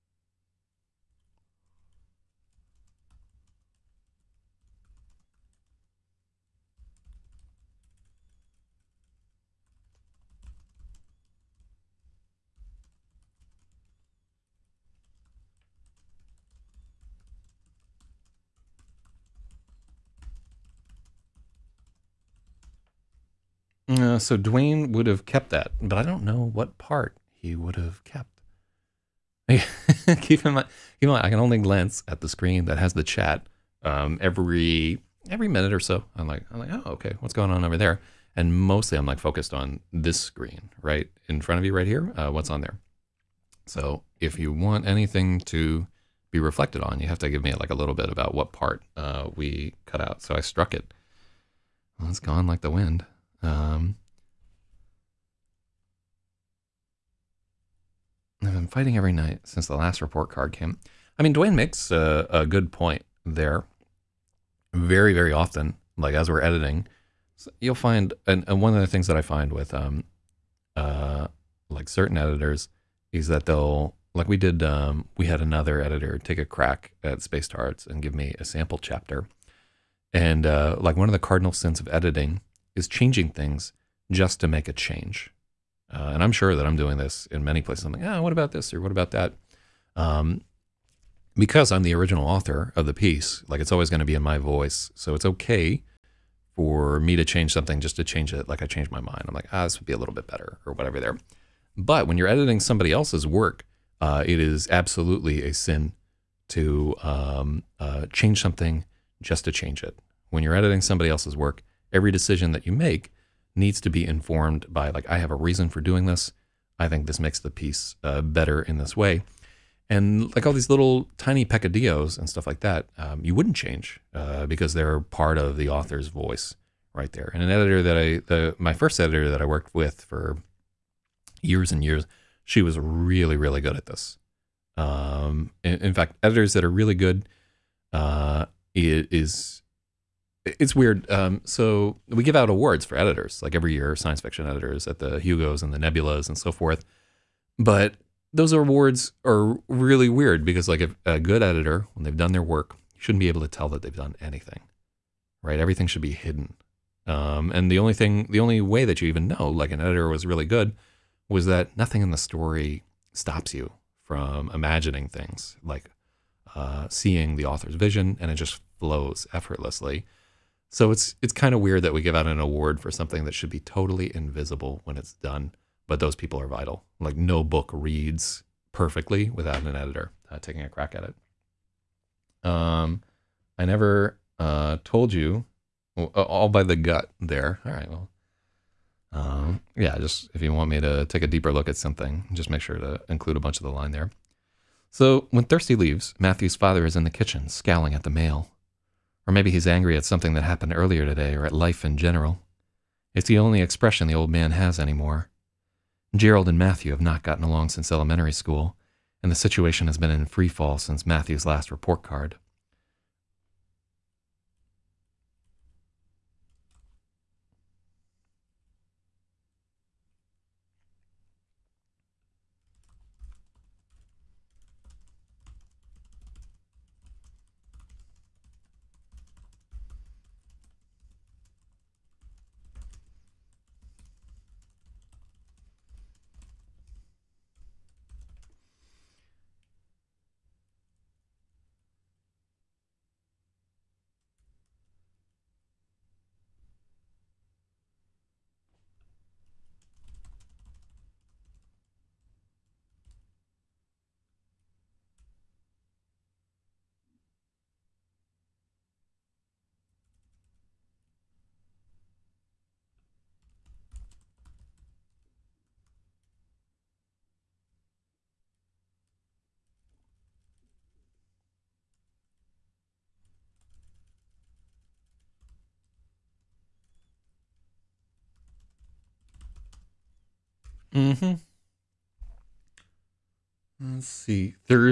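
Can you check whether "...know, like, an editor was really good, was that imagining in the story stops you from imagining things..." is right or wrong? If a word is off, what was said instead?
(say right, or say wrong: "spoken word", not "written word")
wrong: "nothing", not "imagining".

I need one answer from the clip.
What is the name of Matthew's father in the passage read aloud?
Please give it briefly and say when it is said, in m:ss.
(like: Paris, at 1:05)
Gerald, at 3:26.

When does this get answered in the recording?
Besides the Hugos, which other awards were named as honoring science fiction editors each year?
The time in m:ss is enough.
2:25.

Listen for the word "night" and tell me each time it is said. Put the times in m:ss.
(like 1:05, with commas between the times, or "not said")
0:59.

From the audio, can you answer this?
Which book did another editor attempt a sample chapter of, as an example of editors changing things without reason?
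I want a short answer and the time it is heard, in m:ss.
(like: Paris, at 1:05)
Space Darts, at 1:17.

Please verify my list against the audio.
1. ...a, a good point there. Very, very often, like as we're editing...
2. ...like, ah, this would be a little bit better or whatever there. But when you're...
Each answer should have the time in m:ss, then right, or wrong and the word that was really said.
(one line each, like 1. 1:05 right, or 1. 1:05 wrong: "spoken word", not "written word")
1. 1:01 right
2. 1:39 right.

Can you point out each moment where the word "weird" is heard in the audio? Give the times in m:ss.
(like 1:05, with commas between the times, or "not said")
2:20, 2:30, 2:51.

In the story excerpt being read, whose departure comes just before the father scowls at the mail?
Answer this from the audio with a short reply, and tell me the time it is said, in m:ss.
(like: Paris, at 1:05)
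Thirsty, at 3:15.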